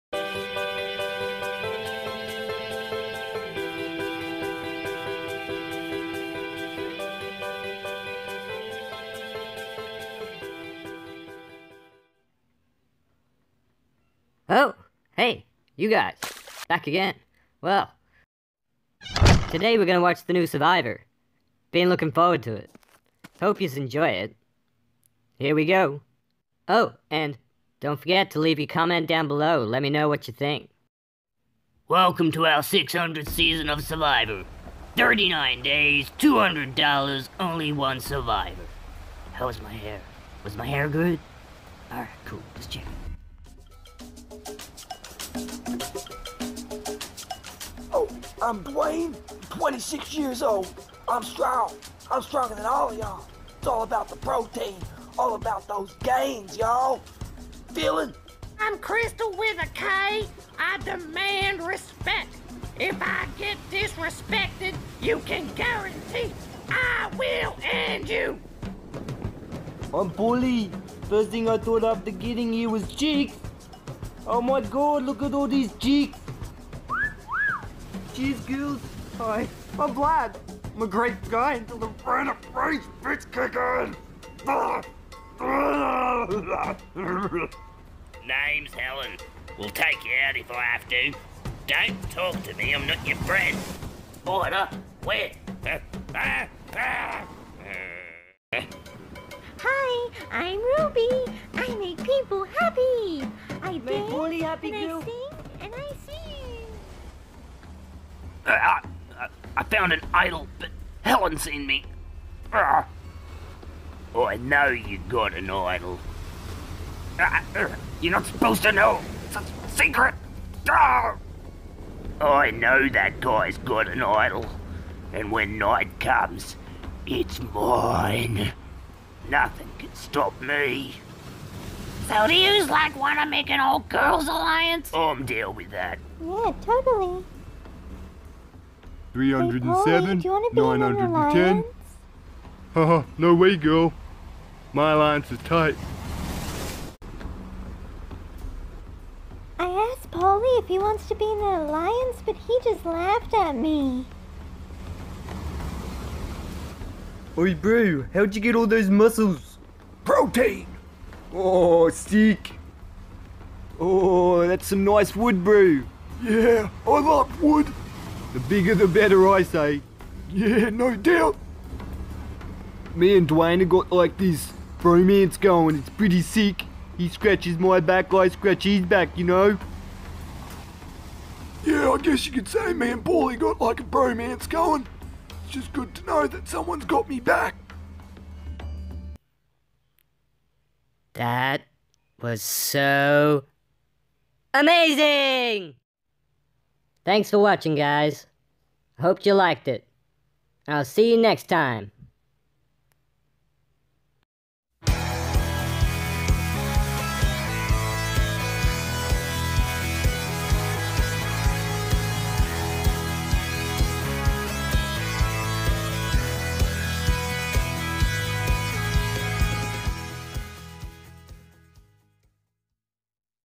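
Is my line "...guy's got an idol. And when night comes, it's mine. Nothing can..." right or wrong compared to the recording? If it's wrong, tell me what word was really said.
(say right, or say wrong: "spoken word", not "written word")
right.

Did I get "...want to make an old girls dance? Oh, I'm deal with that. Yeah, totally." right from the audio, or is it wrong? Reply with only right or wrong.
wrong.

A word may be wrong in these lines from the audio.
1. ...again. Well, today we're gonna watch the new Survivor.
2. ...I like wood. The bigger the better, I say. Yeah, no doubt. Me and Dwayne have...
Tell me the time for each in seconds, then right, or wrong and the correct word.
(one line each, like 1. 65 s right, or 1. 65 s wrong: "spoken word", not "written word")
1. 16 s right
2. 166 s right.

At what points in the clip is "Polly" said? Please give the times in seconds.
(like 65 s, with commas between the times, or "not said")
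140 s, 150 s.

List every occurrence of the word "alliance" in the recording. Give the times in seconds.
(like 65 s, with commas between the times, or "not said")
134 s, 144 s, 151 s.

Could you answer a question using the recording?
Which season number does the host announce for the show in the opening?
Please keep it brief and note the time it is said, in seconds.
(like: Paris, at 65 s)
600th, at 32 s.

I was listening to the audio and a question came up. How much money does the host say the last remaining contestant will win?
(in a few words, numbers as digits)
$200.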